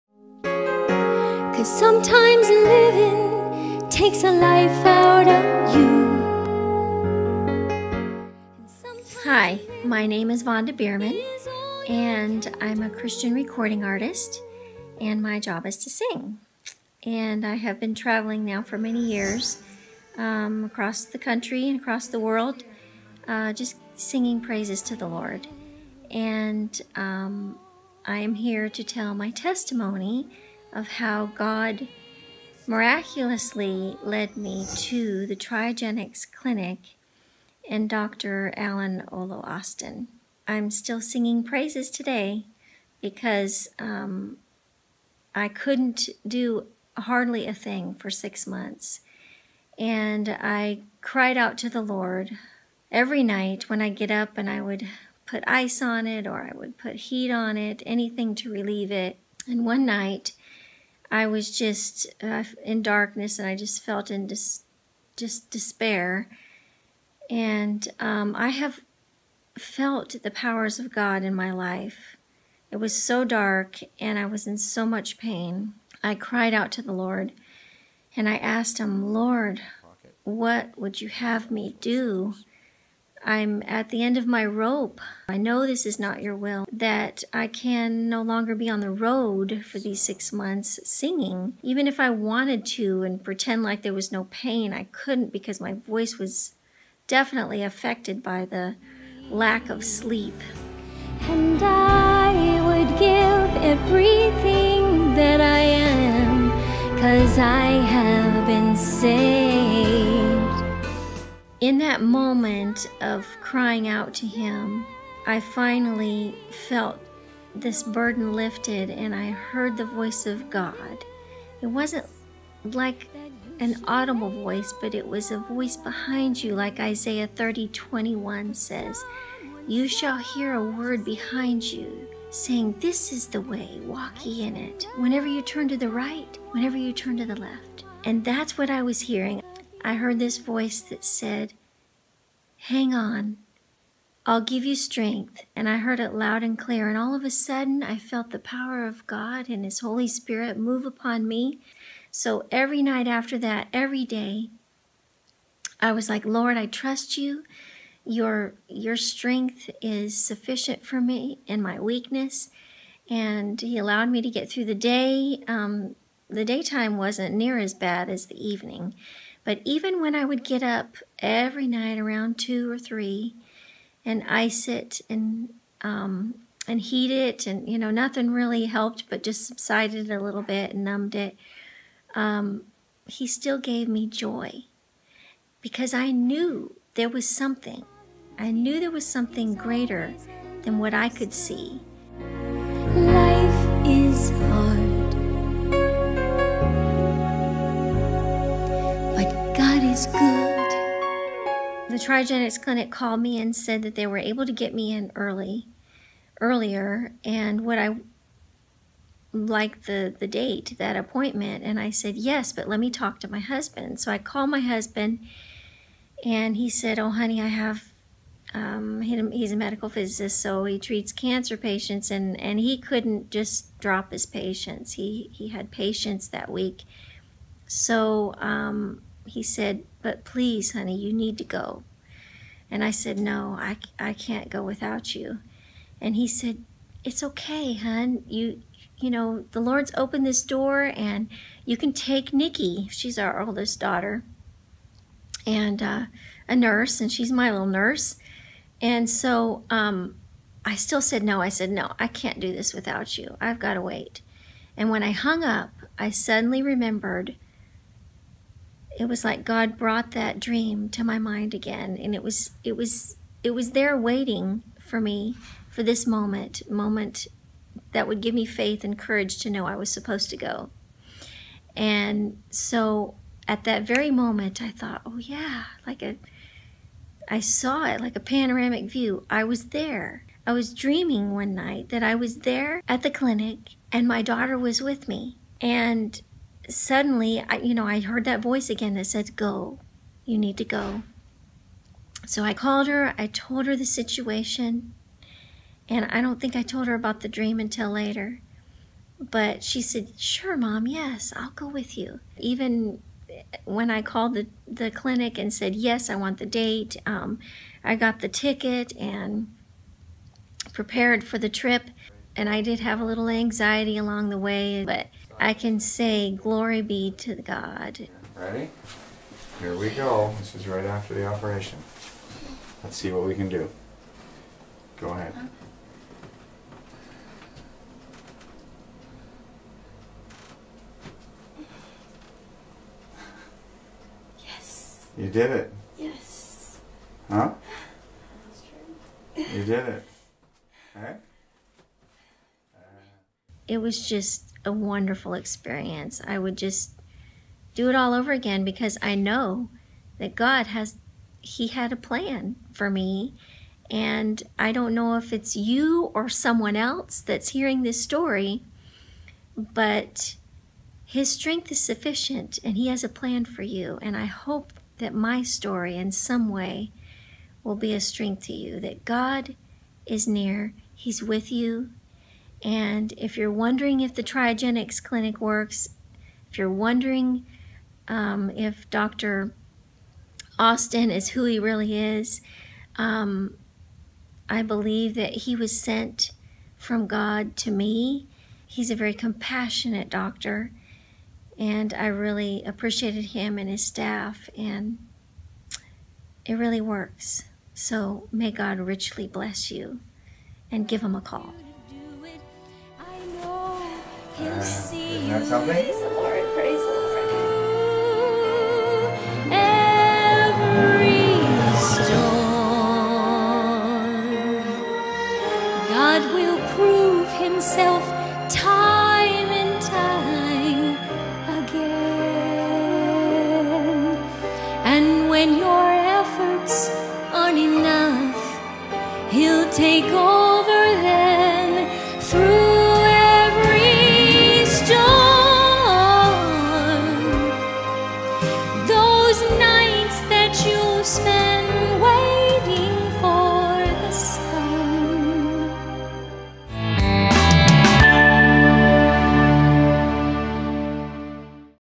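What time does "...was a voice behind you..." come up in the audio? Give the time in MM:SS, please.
02:05.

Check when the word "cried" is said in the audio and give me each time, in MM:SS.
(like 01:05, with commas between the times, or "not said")
00:51, 01:16.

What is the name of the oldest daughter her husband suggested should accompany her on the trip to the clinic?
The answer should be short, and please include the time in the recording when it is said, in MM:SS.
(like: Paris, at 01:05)
Nikki, at 04:02.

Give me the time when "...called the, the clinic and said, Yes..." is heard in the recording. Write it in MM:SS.
05:04.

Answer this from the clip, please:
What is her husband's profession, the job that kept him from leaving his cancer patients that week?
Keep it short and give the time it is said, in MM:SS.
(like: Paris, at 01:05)
Medical physicist, at 03:39.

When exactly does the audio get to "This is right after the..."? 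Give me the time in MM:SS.
05:20.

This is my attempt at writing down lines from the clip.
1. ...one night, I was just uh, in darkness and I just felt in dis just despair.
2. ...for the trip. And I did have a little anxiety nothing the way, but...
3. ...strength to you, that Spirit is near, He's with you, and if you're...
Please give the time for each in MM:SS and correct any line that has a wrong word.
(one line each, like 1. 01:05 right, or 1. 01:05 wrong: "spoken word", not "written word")
1. 00:59 right
2. 05:11 wrong: "along", not "nothing"
3. 06:07 wrong: "God", not "Spirit".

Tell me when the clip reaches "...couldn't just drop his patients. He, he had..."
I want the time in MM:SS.
03:42.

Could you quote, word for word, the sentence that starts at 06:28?
He's a very compassionate doctor, and I really appreciated him and his staff, and it really works.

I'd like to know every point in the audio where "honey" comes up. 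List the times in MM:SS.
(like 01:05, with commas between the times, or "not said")
03:37, 03:50.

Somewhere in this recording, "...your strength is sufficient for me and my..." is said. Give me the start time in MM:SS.
02:38.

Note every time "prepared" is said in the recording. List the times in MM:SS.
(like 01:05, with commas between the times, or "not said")
05:10.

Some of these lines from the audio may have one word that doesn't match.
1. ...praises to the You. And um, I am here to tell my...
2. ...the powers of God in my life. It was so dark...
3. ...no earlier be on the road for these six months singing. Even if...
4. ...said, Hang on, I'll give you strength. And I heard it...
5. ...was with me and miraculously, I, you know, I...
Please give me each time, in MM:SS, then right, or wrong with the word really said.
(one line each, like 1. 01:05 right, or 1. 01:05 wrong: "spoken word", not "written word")
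1. 00:24 wrong: "Lord", not "You"
2. 01:10 right
3. 01:28 wrong: "longer", not "earlier"
4. 02:21 right
5. 04:44 wrong: "suddenly", not "miraculously".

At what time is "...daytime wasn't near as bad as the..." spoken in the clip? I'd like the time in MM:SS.
02:46.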